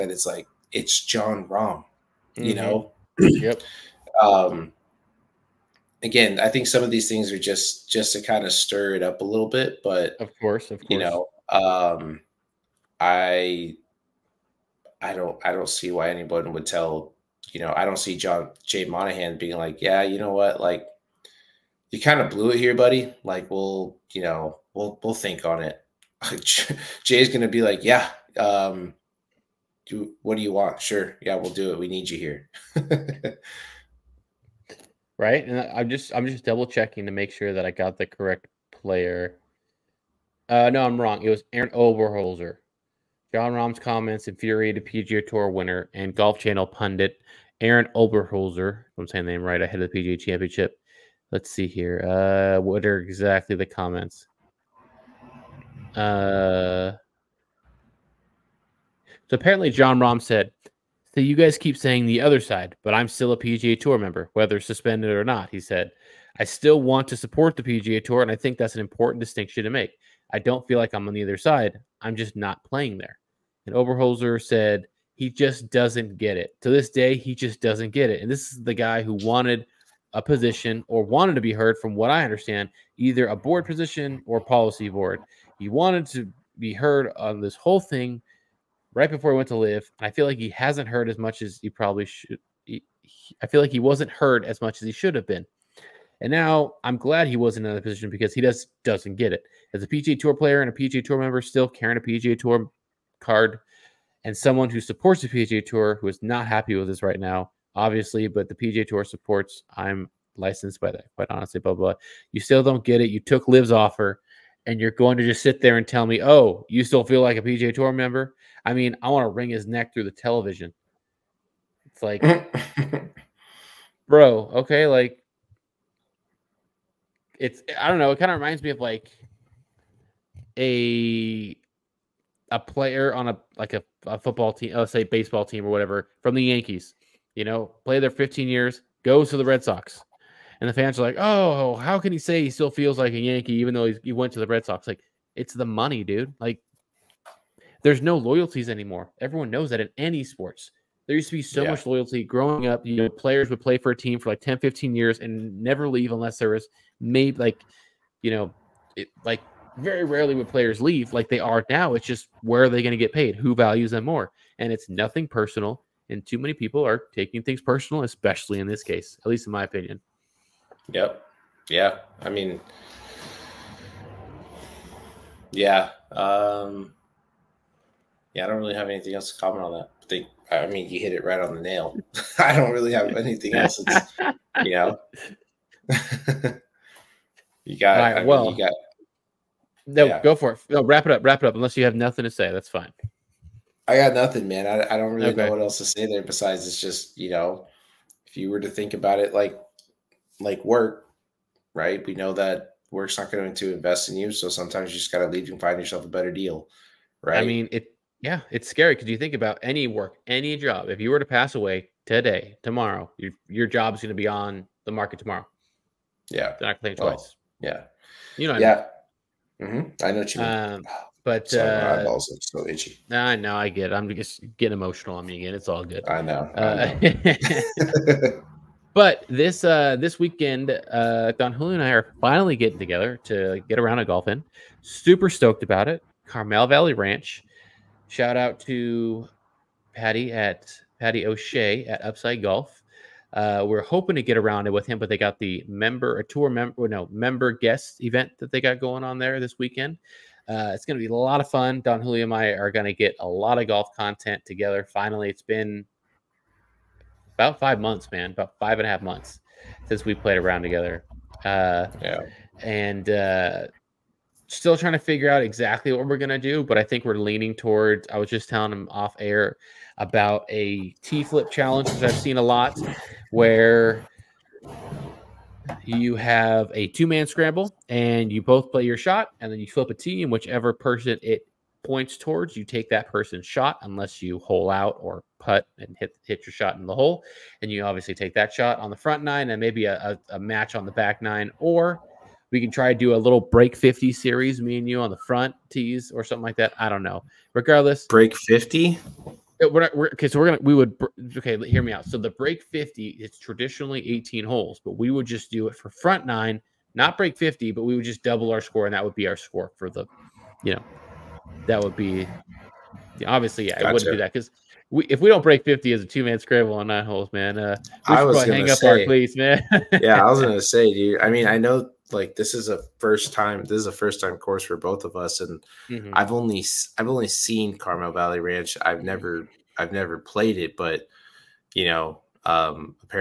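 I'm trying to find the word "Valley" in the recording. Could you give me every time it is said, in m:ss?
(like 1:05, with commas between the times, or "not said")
3:56, 5:28.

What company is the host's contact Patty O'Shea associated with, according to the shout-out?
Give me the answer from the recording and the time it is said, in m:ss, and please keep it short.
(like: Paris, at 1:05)
Upside Golf, at 4:02.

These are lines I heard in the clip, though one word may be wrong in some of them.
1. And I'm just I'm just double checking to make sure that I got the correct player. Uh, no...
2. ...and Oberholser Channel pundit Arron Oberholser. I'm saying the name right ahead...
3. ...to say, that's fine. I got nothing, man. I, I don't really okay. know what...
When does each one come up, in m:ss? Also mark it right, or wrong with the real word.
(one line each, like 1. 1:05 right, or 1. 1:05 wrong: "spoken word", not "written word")
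1. 0:35 right
2. 0:45 wrong: "Golf", not "Oberholser"
3. 3:12 right.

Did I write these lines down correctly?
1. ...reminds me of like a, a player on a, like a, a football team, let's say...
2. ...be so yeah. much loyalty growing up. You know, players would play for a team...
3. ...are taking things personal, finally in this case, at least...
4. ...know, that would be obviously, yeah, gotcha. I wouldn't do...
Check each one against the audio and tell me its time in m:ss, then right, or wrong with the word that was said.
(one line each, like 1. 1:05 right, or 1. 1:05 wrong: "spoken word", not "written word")
1. 2:08 right
2. 2:31 right
3. 2:46 wrong: "especially", not "finally"
4. 5:10 right.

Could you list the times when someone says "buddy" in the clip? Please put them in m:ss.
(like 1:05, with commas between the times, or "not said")
0:22.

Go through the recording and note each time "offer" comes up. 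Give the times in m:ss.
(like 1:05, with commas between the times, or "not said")
1:53.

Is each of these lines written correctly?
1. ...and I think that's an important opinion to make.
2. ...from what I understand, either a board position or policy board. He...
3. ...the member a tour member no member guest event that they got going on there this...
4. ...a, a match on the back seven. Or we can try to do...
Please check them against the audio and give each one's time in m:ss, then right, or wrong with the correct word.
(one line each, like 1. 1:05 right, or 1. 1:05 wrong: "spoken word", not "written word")
1. 1:08 wrong: "distinction", not "opinion"
2. 1:21 right
3. 4:05 right
4. 4:50 wrong: "nine", not "seven".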